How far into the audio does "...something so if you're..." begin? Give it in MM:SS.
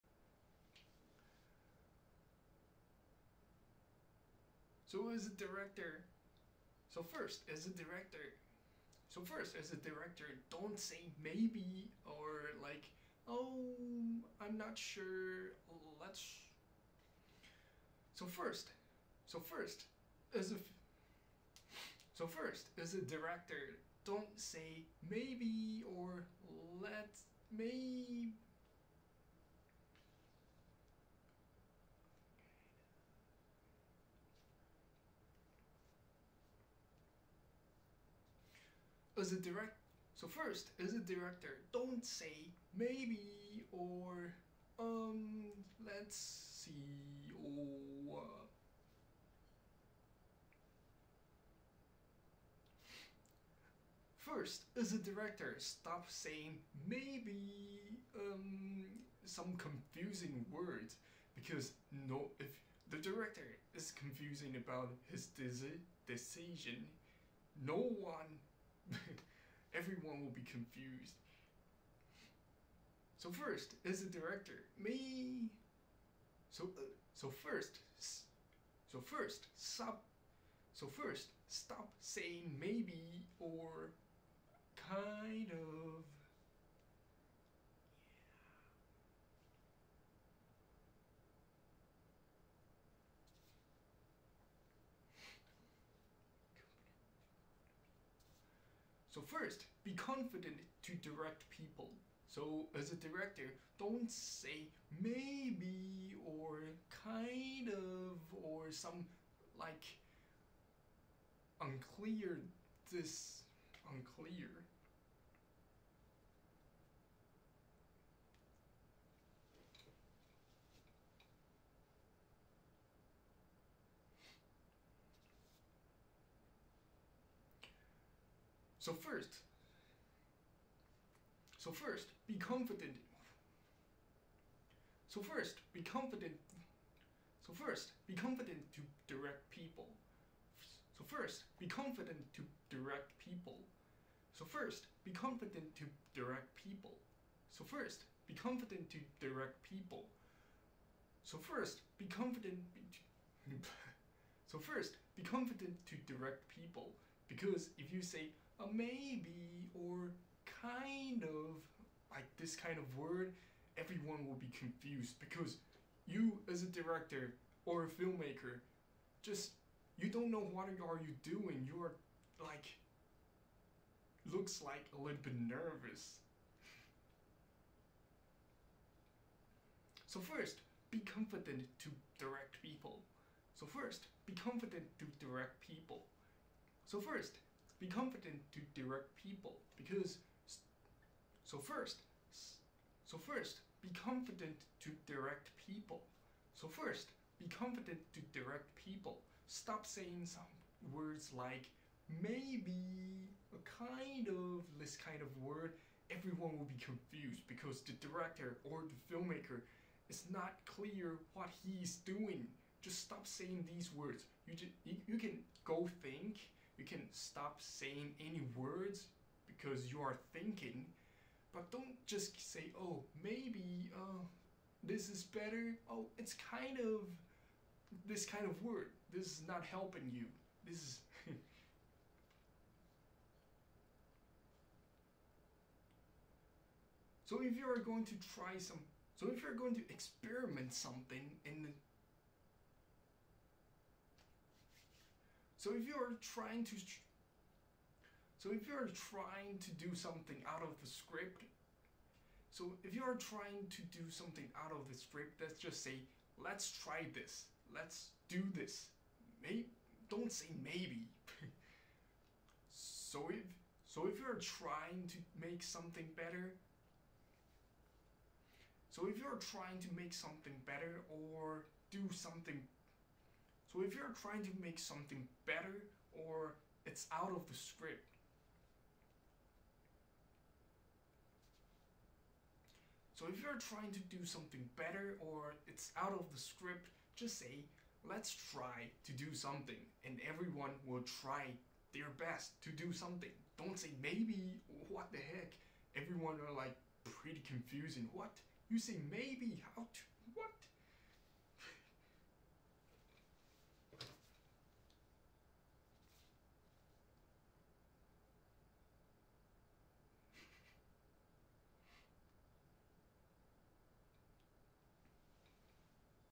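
04:32.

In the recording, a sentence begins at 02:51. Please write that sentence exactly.
You are like looks like a little bit nervous.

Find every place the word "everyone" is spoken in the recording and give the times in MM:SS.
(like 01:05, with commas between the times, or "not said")
01:09, 02:43, 03:26, 04:50, 04:55.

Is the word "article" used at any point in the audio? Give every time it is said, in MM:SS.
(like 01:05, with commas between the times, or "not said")
not said.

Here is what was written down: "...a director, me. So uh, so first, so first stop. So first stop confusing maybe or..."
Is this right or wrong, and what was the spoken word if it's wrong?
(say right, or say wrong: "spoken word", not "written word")
wrong: "saying", not "confusing".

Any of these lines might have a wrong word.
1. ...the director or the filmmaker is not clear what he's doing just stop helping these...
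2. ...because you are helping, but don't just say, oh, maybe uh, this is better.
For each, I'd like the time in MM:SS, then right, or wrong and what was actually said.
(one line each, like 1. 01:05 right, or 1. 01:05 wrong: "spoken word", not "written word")
1. 03:27 wrong: "saying", not "helping"
2. 03:39 wrong: "thinking", not "helping".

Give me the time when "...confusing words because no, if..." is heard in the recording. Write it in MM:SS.
00:59.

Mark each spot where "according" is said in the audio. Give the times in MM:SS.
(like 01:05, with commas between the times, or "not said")
not said.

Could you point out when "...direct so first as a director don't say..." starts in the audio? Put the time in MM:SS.
00:39.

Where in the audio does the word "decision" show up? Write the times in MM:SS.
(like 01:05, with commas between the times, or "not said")
01:06.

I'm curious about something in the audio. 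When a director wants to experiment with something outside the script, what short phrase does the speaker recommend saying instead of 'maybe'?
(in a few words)
Let's try this.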